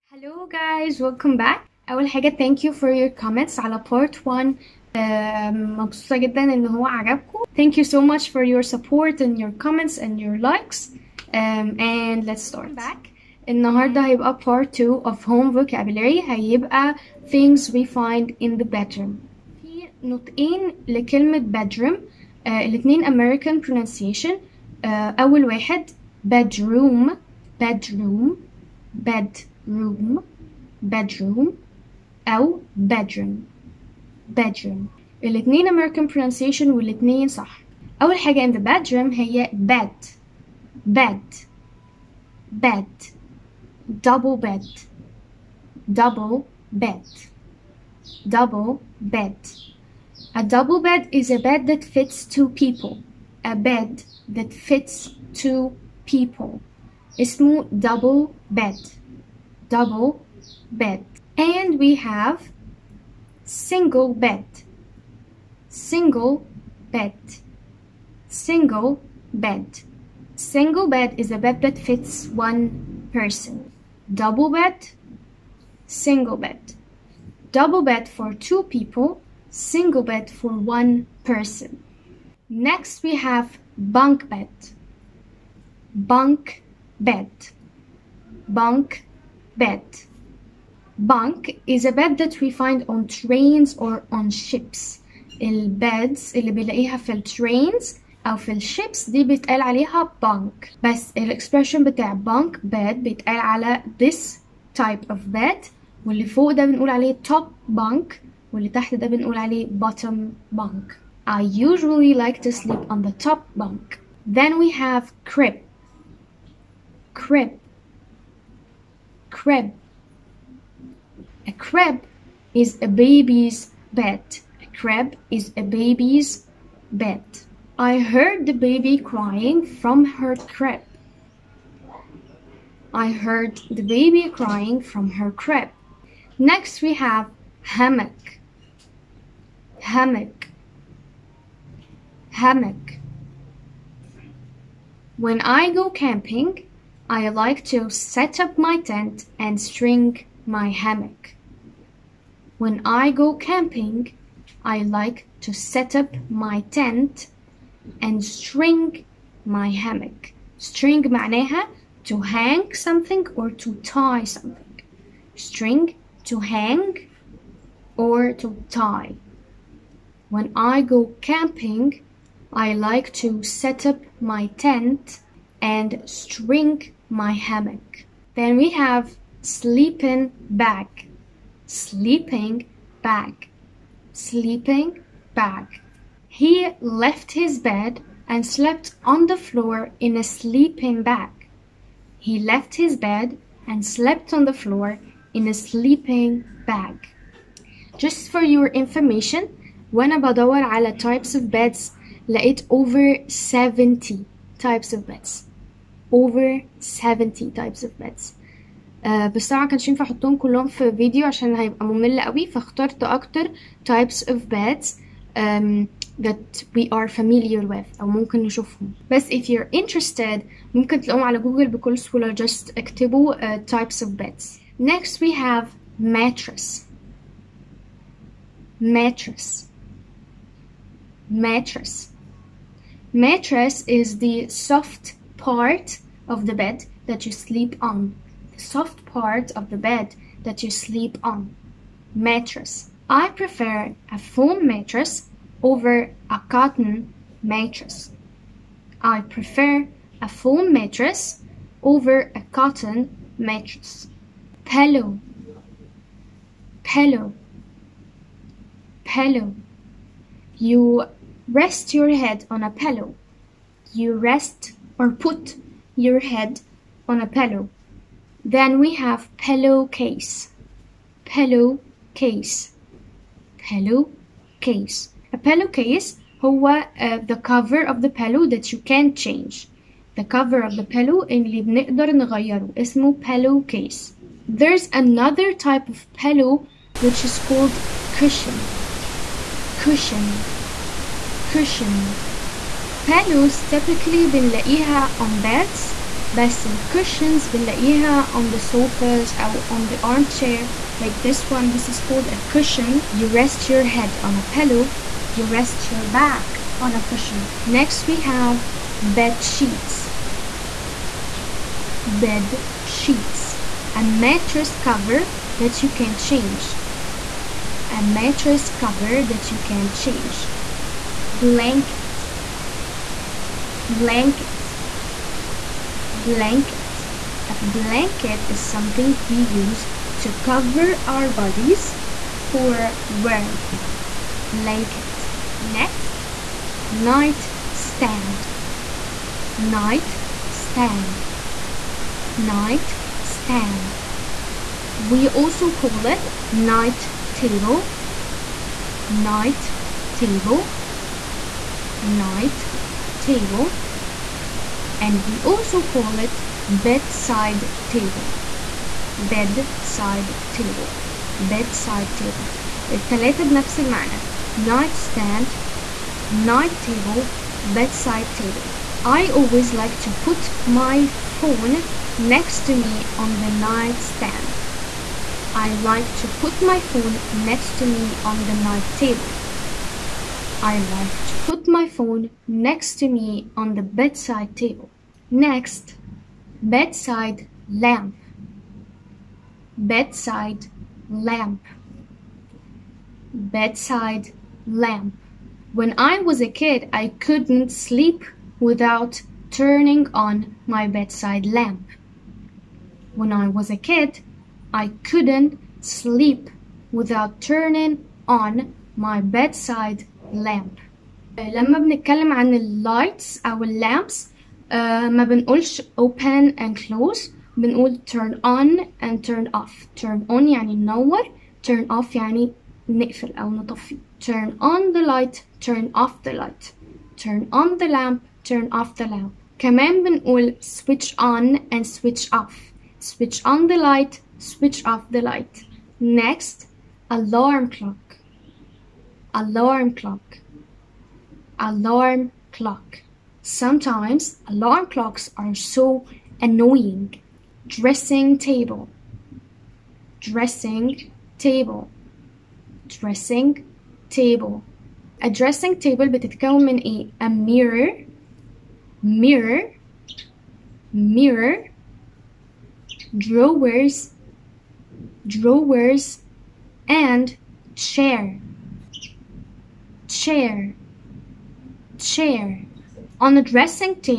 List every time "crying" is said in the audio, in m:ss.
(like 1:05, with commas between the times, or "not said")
2:08, 2:14.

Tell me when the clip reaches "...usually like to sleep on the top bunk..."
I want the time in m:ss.
1:51.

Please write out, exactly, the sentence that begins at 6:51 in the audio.
لما بنتكلم عن lights أو lamps.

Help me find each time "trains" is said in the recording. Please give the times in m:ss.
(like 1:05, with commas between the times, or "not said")
1:33, 1:37.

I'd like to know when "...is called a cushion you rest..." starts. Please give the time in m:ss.
5:01.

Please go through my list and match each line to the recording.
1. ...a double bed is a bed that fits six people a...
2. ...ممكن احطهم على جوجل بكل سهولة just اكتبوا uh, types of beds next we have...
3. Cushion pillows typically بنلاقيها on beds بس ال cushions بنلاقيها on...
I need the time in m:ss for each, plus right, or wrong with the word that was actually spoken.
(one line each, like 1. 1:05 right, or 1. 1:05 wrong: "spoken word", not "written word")
1. 0:50 wrong: "two", not "six"
2. 3:40 wrong: "تلاقوهم", not "احطهم"
3. 4:51 right.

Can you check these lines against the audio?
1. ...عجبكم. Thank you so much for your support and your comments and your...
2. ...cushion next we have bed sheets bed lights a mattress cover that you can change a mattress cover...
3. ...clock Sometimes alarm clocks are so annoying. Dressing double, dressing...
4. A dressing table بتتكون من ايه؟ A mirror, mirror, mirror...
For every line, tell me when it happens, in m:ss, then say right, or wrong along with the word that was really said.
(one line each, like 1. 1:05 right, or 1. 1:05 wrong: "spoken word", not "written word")
1. 0:06 right
2. 5:07 wrong: "sheets", not "lights"
3. 7:22 wrong: "table", not "double"
4. 7:35 right.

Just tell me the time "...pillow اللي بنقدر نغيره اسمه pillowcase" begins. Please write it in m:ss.
4:40.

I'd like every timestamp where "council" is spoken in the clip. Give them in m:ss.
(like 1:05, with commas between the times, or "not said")
not said.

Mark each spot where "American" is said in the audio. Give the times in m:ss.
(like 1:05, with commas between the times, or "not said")
0:23, 0:35.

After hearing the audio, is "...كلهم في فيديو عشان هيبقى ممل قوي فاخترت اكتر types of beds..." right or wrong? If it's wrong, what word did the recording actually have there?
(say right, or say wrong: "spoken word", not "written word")
right.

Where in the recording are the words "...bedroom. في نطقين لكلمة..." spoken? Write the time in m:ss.
0:18.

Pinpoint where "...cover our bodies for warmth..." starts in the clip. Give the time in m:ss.
5:30.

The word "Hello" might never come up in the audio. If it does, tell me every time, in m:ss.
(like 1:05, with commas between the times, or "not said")
0:00.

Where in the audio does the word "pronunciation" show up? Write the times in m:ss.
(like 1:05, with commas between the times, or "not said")
0:23, 0:36.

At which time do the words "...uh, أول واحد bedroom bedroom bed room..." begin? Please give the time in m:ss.
0:24.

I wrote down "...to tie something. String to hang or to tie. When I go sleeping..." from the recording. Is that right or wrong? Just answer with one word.
wrong.